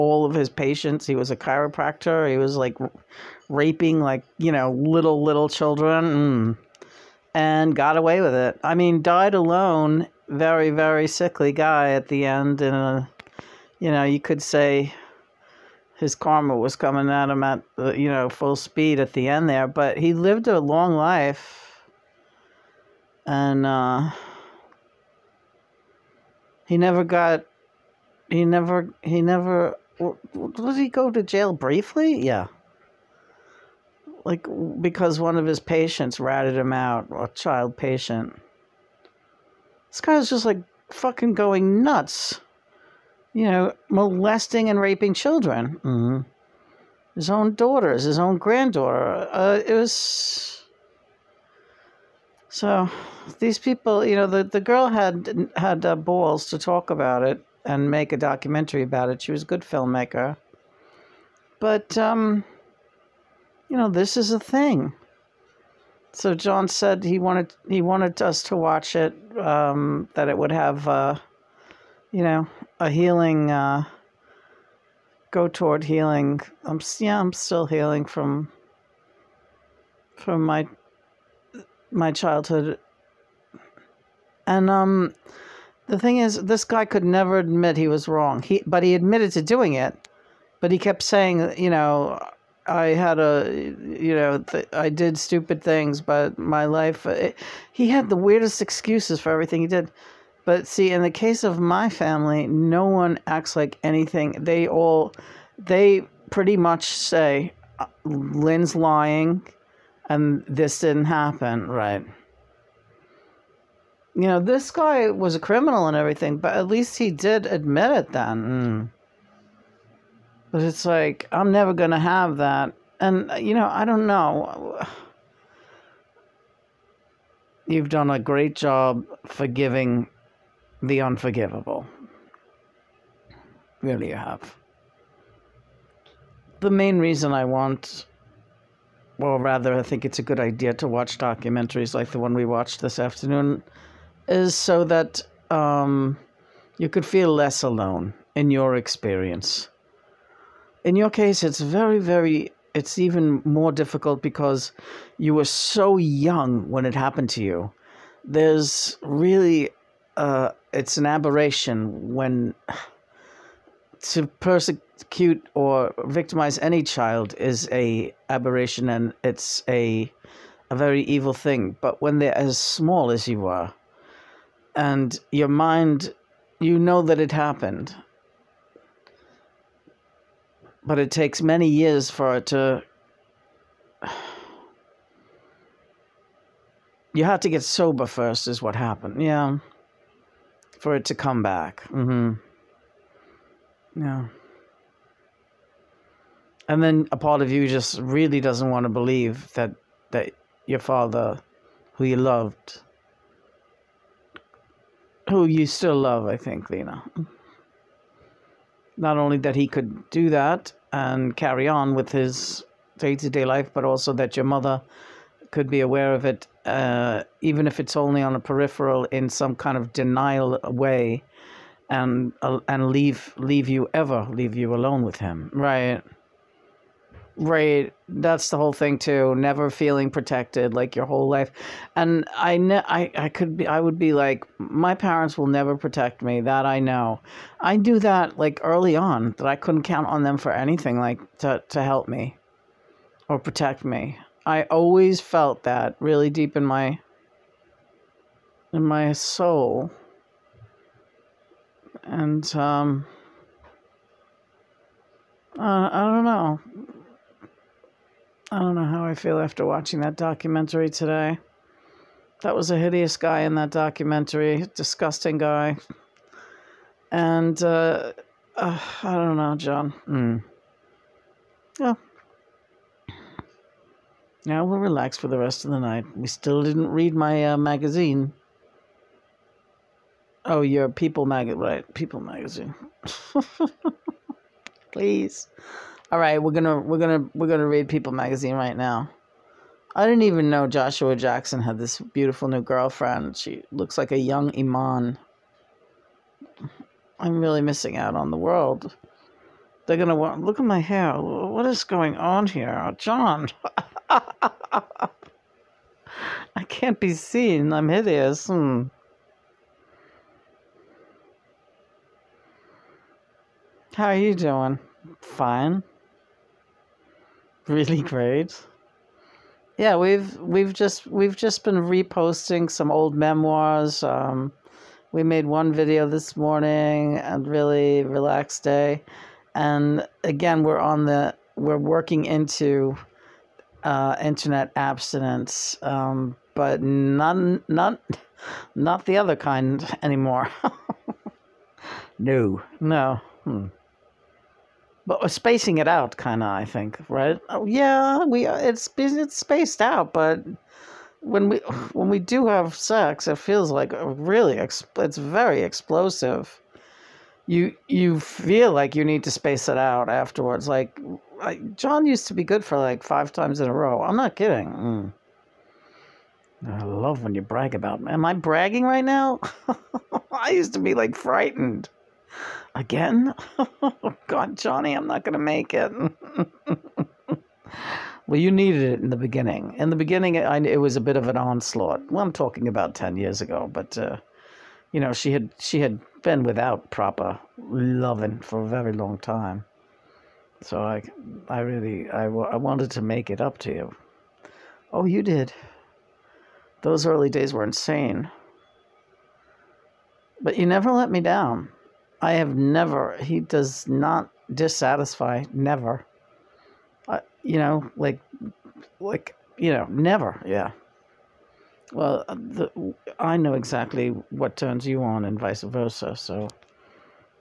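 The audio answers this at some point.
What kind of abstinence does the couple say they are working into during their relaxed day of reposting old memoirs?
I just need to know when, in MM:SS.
05:34.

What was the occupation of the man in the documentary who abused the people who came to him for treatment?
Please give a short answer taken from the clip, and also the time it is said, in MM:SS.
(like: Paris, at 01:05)
Chiropractor, at 00:01.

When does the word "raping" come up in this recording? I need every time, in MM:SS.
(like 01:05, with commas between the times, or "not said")
00:03, 00:44.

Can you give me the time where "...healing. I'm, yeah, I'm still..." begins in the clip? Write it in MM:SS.
01:15.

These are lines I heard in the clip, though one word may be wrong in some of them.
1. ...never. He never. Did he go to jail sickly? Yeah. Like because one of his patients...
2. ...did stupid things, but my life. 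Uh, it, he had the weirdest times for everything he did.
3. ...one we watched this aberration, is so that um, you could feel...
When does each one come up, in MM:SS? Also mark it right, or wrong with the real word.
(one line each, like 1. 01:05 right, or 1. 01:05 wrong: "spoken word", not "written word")
1. 00:28 wrong: "briefly", not "sickly"
2. 01:34 wrong: "excuses", not "times"
3. 02:22 wrong: "afternoon", not "aberration".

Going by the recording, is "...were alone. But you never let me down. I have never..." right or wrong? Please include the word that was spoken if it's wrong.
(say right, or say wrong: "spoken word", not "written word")
wrong: "insane", not "alone".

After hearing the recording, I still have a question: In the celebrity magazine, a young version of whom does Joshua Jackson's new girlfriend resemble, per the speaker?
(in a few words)
Iman.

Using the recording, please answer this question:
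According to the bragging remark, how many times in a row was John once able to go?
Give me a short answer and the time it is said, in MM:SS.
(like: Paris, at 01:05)
5, at 06:03.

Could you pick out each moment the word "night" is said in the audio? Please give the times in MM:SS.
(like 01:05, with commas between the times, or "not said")
04:35.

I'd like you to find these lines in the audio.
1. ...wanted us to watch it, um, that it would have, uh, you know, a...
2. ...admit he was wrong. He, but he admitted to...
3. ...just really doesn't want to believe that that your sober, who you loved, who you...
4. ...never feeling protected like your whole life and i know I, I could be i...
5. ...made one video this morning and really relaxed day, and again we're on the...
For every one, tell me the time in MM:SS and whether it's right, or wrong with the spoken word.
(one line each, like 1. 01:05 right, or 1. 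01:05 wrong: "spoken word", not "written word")
1. 01:07 right
2. 01:27 right
3. 03:17 wrong: "father", not "sober"
4. 03:49 right
5. 05:25 right.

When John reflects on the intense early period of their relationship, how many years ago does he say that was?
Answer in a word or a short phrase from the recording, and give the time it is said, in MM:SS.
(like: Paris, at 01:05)
10 years, at 06:22.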